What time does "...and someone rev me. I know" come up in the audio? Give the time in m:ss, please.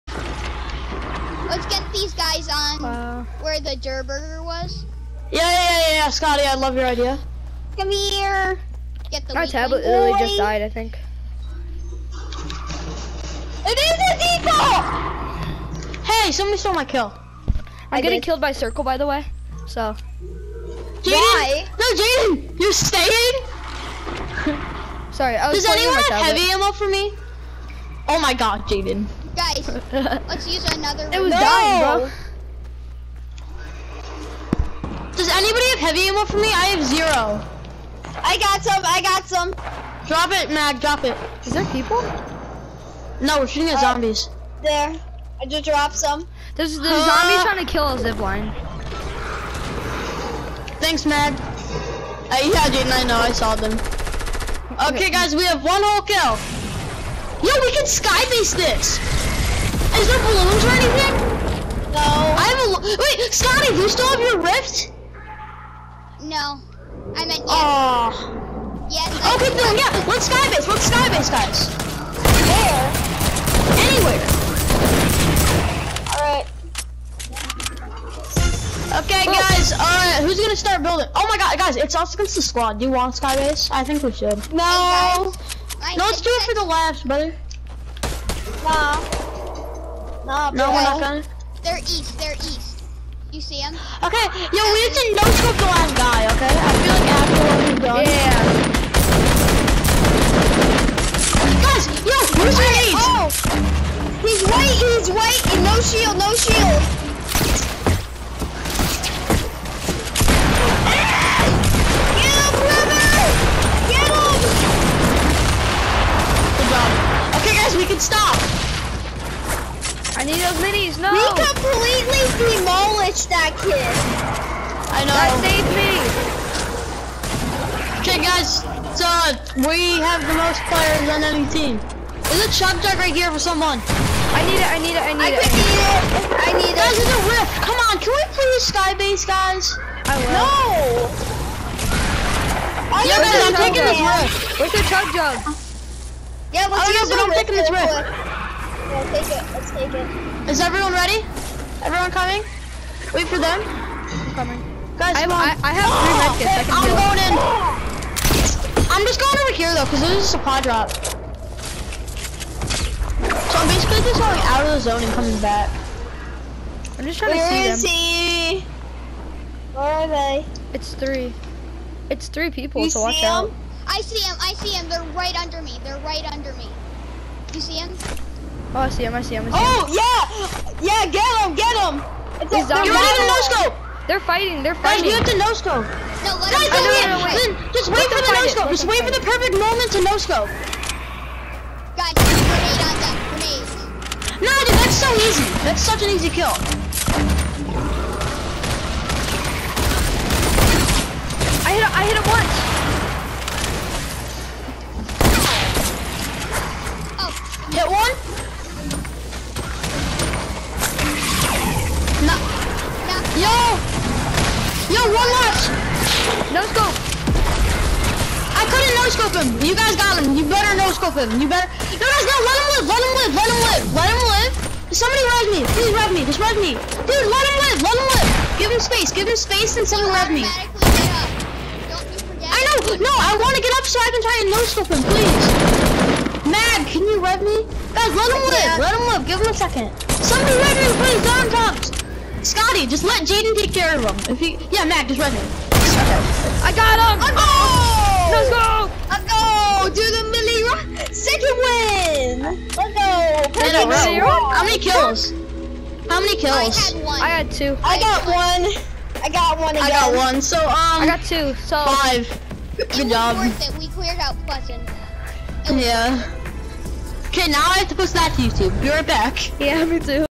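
3:49.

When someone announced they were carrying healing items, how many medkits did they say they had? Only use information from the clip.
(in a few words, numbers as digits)
3.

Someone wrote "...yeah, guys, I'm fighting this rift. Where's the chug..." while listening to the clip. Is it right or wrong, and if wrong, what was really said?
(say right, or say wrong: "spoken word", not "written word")
wrong: "taking", not "fighting".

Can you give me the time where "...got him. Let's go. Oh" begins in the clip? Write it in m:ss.
4:06.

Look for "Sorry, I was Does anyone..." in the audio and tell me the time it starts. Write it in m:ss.
0:25.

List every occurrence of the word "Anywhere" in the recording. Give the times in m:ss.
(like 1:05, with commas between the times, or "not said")
1:13.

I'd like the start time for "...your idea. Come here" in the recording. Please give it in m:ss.
0:06.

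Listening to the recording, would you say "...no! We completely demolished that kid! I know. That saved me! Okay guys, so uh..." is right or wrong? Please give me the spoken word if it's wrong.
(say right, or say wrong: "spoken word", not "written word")
right.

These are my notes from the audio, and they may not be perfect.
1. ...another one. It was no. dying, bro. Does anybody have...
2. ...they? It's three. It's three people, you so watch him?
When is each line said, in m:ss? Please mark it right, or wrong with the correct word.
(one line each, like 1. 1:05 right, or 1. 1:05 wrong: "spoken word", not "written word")
1. 0:30 right
2. 2:50 right.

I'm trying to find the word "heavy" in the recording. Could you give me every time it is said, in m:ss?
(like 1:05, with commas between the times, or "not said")
0:26, 0:35.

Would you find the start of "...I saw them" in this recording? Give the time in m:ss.
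0:53.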